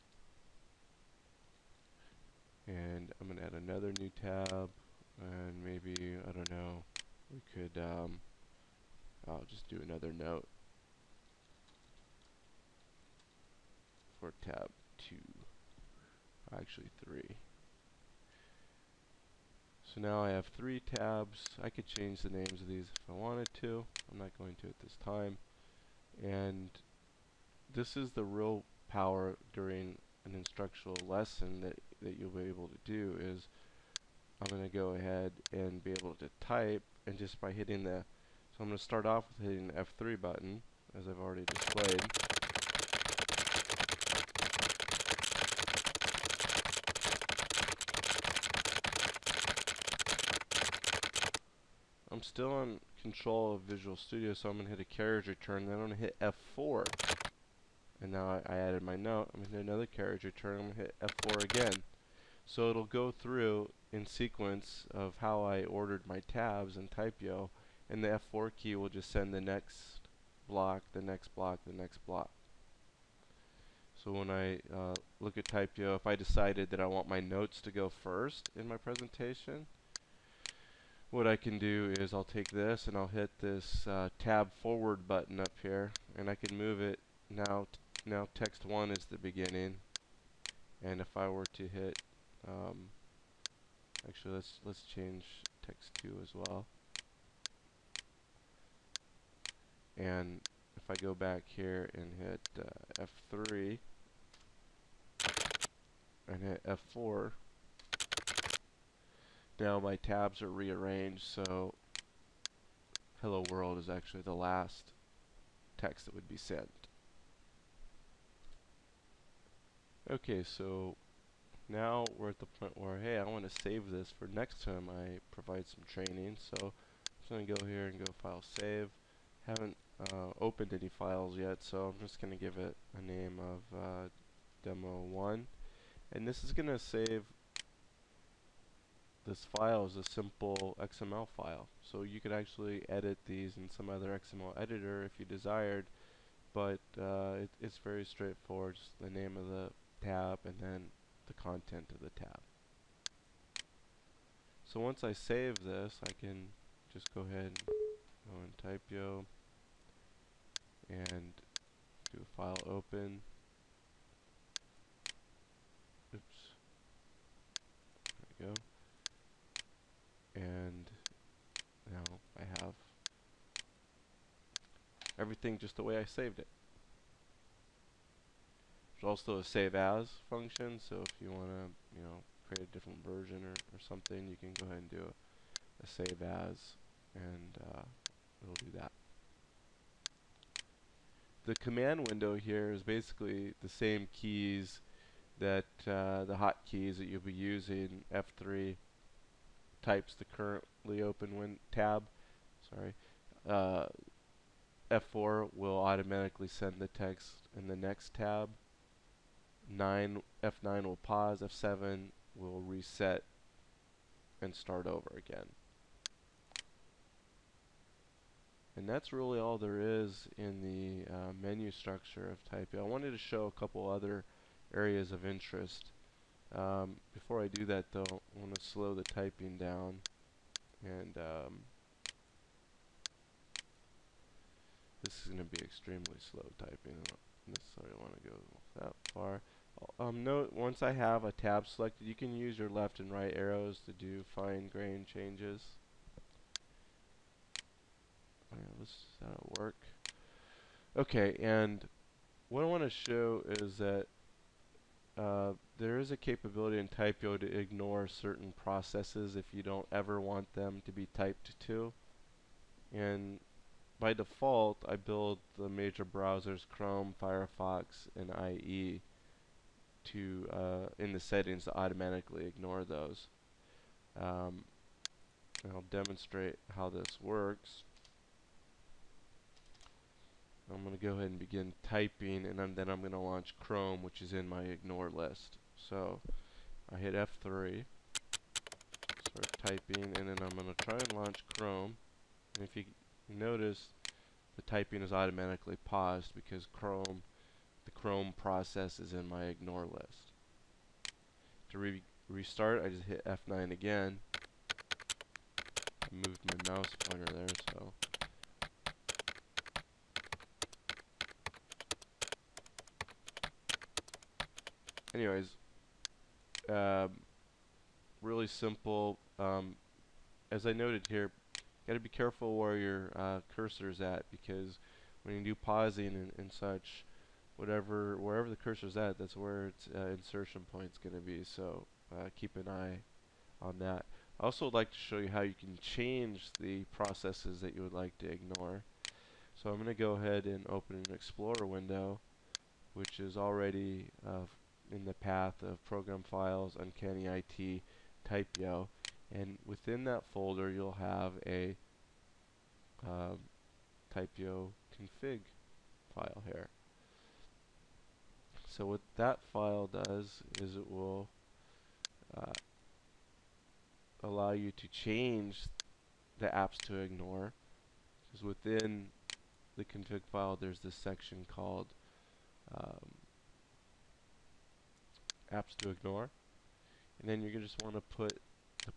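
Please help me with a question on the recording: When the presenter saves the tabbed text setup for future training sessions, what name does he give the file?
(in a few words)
Demo 1.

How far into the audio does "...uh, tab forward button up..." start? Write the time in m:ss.
1:23.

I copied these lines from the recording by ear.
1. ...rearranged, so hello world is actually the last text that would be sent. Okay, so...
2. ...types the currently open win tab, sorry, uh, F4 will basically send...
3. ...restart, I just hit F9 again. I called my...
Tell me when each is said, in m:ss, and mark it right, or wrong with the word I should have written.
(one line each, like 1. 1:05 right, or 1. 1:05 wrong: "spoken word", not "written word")
1. 1:50 right
2. 3:19 wrong: "automatically", not "basically"
3. 5:02 wrong: "moved", not "called".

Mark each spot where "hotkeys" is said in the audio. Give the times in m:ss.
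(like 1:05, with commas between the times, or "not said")
3:16.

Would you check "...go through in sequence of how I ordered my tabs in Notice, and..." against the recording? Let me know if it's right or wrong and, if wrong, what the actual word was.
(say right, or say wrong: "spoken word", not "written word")
wrong: "TypYo", not "Notice".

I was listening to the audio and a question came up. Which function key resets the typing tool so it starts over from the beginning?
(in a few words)
F7.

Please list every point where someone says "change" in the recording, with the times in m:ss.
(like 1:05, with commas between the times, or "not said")
0:21, 1:34, 4:05, 5:35, 6:04.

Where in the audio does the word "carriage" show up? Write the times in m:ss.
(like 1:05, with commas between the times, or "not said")
0:54, 0:59.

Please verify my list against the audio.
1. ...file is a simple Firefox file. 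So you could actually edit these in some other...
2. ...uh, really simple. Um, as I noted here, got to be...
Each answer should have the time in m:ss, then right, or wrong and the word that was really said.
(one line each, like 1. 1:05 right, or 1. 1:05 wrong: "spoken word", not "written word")
1. 2:19 wrong: "XML", not "Firefox"
2. 5:16 right.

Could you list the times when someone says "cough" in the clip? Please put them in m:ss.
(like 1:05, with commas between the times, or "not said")
not said.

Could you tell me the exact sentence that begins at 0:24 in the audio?
I'm not going to at this time.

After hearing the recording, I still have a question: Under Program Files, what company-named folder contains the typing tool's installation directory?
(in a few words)
Uncanny IT.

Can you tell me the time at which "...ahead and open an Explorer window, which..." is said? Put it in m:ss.
5:40.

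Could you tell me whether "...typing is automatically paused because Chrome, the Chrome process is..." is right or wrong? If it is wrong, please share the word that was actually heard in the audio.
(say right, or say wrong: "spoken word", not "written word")
right.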